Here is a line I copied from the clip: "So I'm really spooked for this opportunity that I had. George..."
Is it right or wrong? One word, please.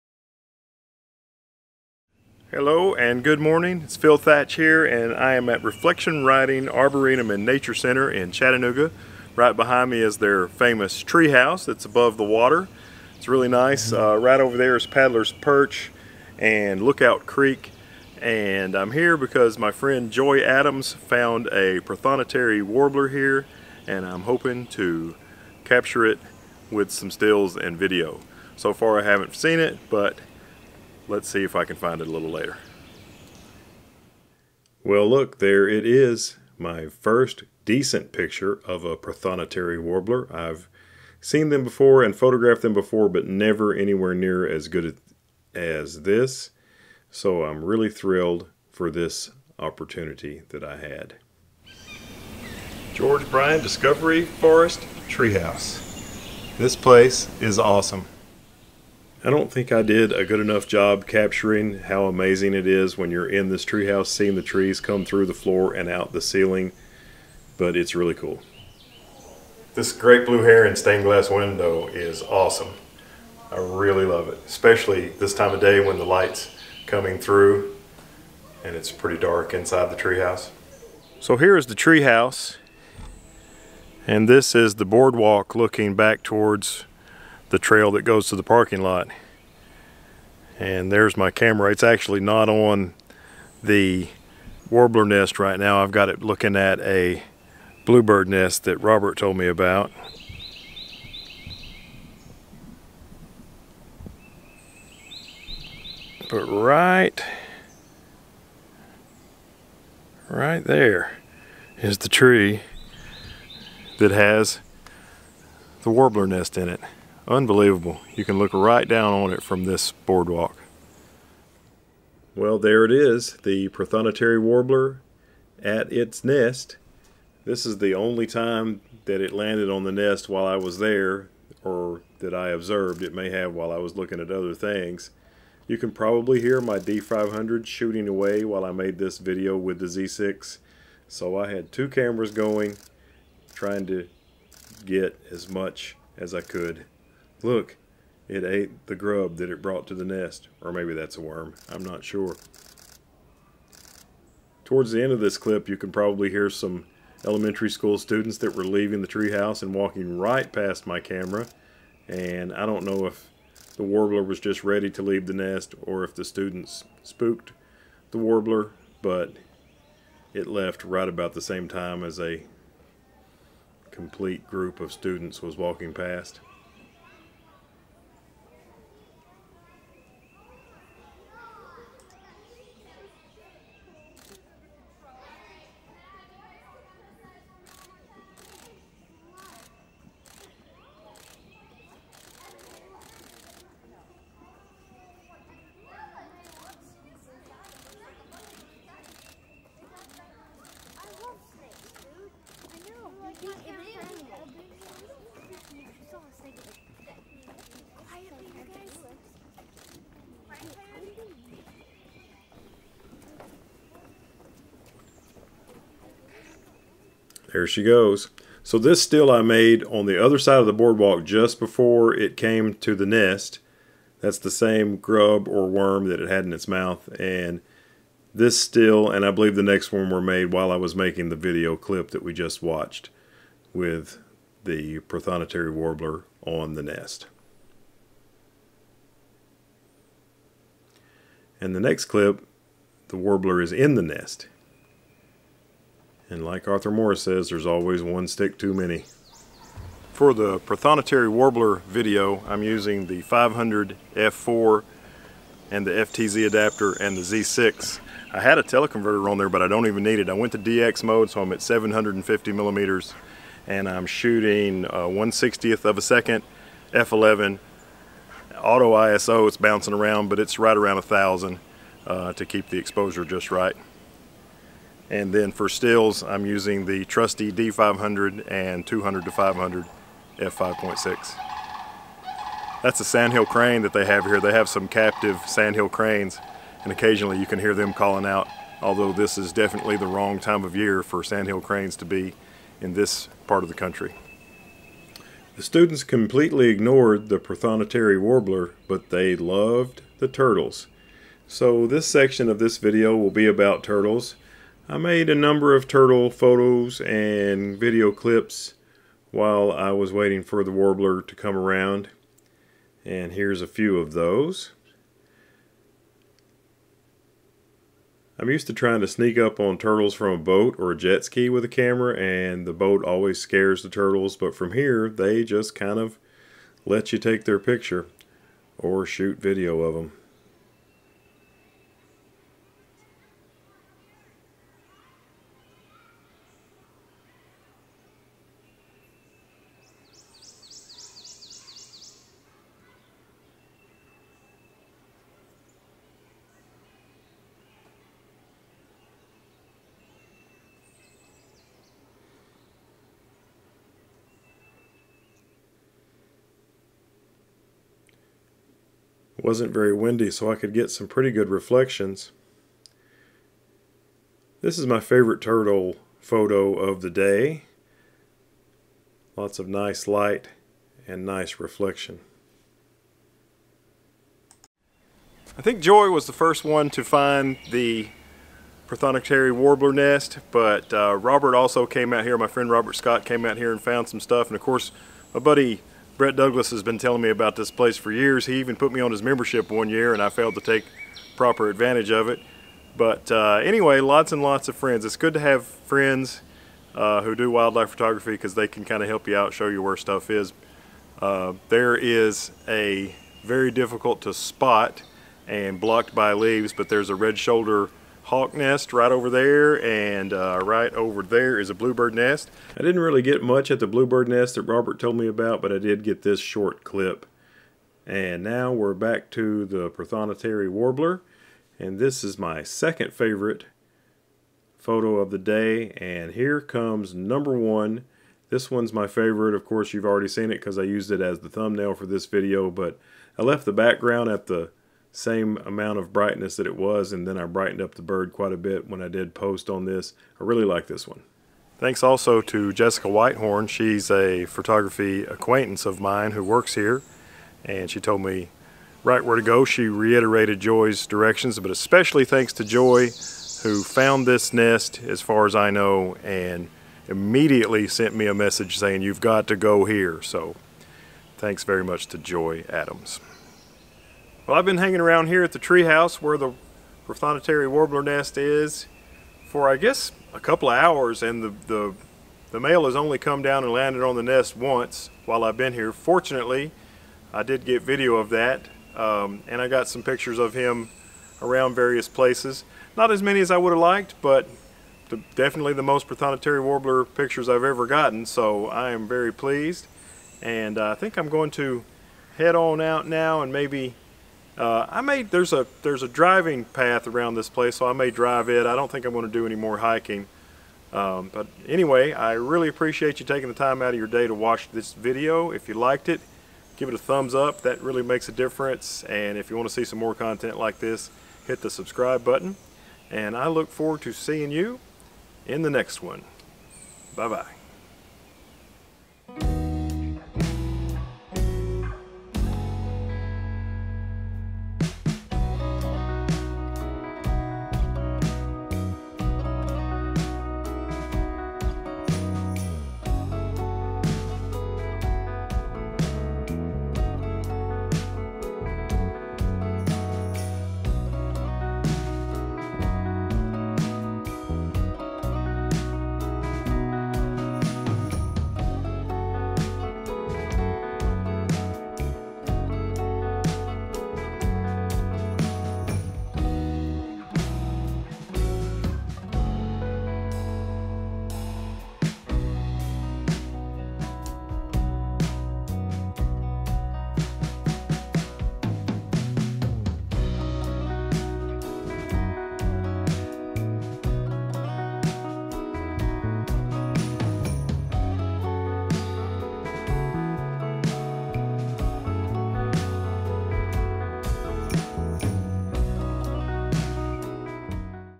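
wrong.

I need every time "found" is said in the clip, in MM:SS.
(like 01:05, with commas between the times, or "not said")
00:20, 06:23, 07:33.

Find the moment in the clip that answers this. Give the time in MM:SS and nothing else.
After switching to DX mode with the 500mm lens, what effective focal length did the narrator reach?
04:21.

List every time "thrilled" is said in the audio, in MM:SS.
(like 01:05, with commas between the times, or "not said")
00:47.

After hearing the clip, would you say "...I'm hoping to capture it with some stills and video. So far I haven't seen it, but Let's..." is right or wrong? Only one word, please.
right.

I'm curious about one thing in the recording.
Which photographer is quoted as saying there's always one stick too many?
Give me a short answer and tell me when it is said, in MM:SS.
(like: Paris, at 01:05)
Arthur Morris, at 04:06.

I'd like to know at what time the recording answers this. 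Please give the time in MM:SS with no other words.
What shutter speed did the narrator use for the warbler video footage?
04:25.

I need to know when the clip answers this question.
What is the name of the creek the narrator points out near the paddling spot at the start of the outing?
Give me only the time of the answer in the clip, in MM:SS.
00:16.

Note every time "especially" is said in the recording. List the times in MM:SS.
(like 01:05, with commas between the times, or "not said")
01:14, 07:31.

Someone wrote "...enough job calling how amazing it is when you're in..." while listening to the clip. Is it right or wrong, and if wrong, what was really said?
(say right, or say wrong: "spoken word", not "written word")
wrong: "capturing", not "calling".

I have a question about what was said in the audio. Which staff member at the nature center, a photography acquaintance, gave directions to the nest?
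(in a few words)
Jessica Whitehorn.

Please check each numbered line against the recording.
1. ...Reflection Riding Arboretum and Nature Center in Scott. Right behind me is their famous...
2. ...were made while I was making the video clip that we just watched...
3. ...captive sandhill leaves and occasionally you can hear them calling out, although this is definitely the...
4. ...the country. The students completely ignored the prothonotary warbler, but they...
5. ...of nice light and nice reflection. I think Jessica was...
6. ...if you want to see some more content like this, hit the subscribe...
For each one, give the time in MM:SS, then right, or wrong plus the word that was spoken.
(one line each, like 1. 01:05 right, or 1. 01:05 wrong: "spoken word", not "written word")
1. 00:05 wrong: "Chattanooga", not "Scott"
2. 03:50 right
3. 04:44 wrong: "cranes", not "leaves"
4. 04:53 right
5. 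06:09 wrong: "Joy", not "Jessica"
6. 08:29 right.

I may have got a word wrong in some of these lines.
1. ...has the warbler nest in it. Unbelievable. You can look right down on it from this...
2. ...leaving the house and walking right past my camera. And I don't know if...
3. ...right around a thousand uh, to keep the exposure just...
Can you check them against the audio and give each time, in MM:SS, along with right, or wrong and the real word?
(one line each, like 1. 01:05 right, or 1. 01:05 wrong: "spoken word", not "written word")
1. 01:54 right
2. 02:38 wrong: "treehouse", not "house"
3. 04:30 right.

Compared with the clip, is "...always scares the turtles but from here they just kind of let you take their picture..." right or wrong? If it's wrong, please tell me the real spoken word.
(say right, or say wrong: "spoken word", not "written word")
right.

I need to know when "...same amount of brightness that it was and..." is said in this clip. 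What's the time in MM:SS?
07:15.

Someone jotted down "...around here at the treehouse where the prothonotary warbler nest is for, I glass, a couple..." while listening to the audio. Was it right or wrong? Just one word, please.
wrong.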